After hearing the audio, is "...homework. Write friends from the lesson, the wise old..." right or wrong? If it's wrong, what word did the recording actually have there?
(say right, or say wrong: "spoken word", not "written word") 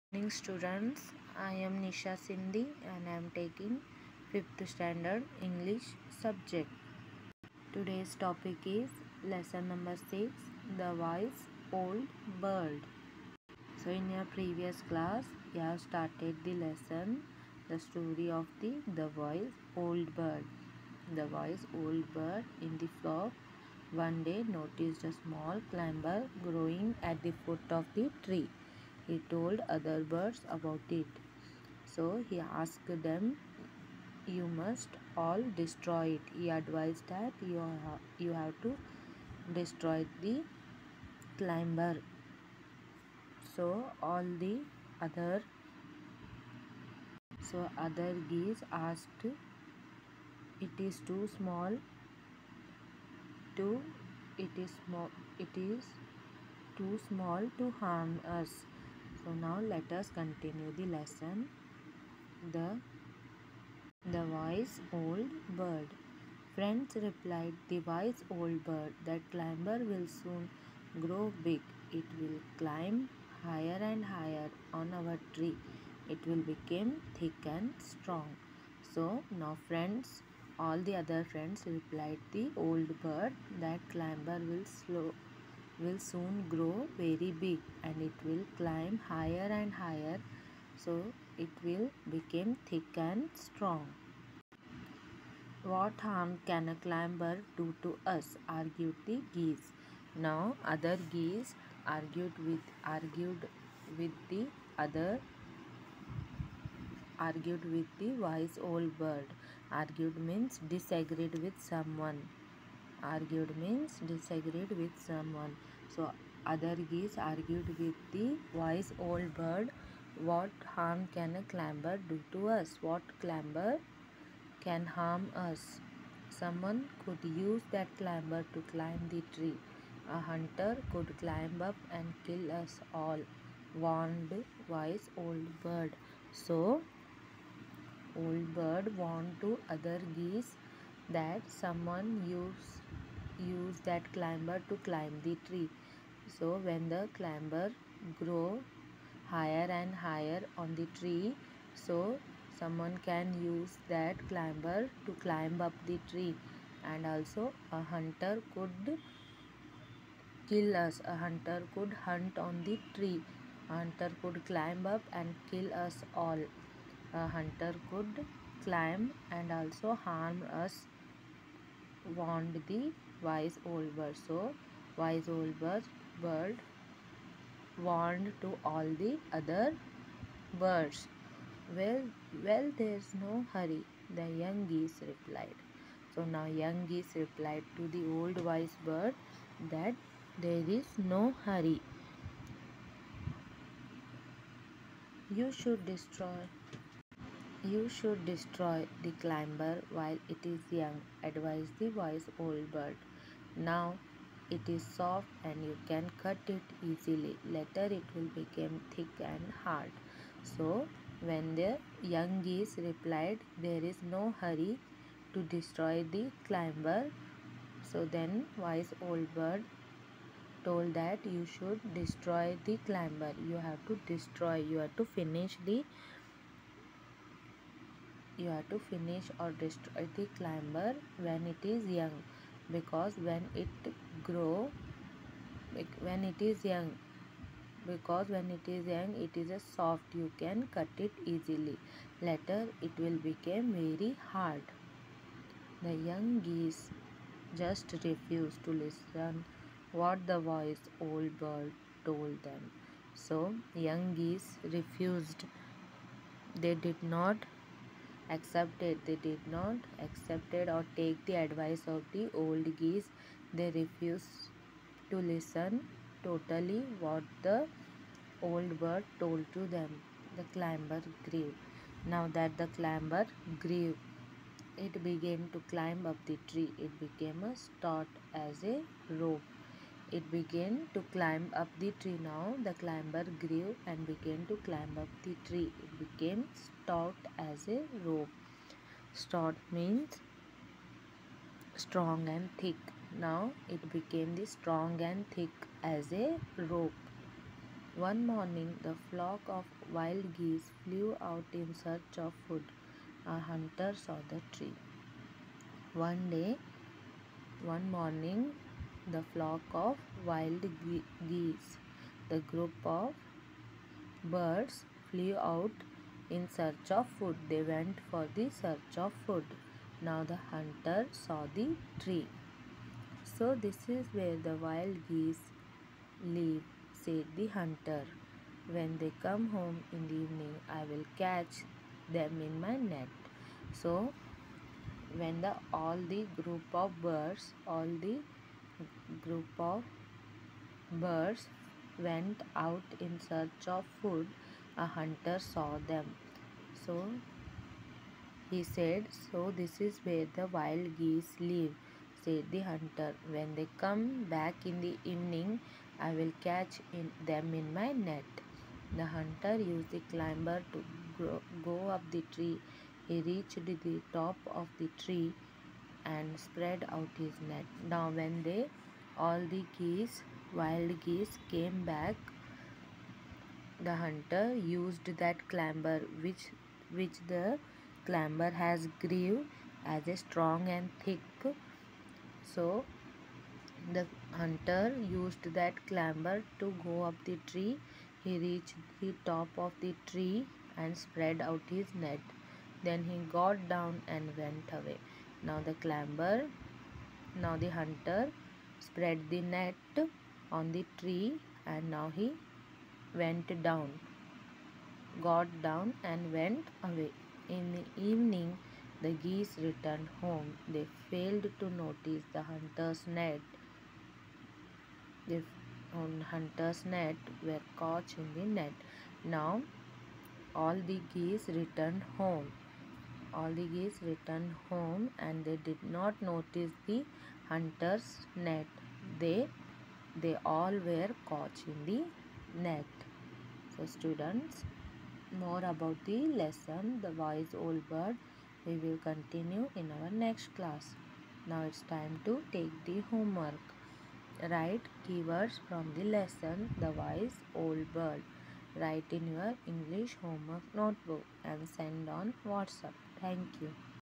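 wrong: "keywords", not "friends".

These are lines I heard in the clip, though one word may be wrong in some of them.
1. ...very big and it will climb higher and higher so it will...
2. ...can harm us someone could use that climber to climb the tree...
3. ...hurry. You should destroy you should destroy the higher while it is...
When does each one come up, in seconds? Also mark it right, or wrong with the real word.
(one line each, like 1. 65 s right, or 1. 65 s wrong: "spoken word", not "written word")
1. 86 s right
2. 124 s right
3. 191 s wrong: "climber", not "higher".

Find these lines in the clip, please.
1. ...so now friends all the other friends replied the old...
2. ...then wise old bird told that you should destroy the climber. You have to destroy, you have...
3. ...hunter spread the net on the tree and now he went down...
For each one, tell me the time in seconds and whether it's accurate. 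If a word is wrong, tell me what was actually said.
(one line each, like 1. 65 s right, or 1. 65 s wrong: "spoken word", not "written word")
1. 78 s right
2. 218 s right
3. 397 s right.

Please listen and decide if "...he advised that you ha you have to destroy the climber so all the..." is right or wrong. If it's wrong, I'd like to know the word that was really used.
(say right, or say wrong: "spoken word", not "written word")
right.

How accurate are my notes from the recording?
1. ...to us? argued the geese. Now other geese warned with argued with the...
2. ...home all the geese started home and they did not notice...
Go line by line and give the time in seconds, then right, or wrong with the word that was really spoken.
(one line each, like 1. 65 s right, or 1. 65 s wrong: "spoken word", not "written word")
1. 97 s wrong: "argued", not "warned"
2. 422 s wrong: "returned", not "started".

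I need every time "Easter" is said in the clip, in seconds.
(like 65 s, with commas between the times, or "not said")
not said.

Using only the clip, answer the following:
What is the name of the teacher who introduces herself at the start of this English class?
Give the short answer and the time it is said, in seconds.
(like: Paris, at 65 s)
Nisha Sindhi, at 1 s.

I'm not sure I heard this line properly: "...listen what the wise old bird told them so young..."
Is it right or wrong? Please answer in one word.
right.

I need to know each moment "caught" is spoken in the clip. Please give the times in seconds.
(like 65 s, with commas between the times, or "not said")
417 s, 431 s.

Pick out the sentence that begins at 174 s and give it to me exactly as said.
So, wise old bird, bird warned to all the other birds.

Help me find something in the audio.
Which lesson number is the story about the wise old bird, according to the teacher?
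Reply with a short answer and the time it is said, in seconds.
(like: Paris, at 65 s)
6, at 9 s.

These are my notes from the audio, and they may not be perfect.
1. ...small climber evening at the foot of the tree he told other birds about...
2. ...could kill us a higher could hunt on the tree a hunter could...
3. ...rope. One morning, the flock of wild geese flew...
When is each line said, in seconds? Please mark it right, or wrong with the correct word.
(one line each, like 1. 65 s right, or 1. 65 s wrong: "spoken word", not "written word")
1. 25 s wrong: "growing", not "evening"
2. 158 s wrong: "hunter", not "higher"
3. 296 s right.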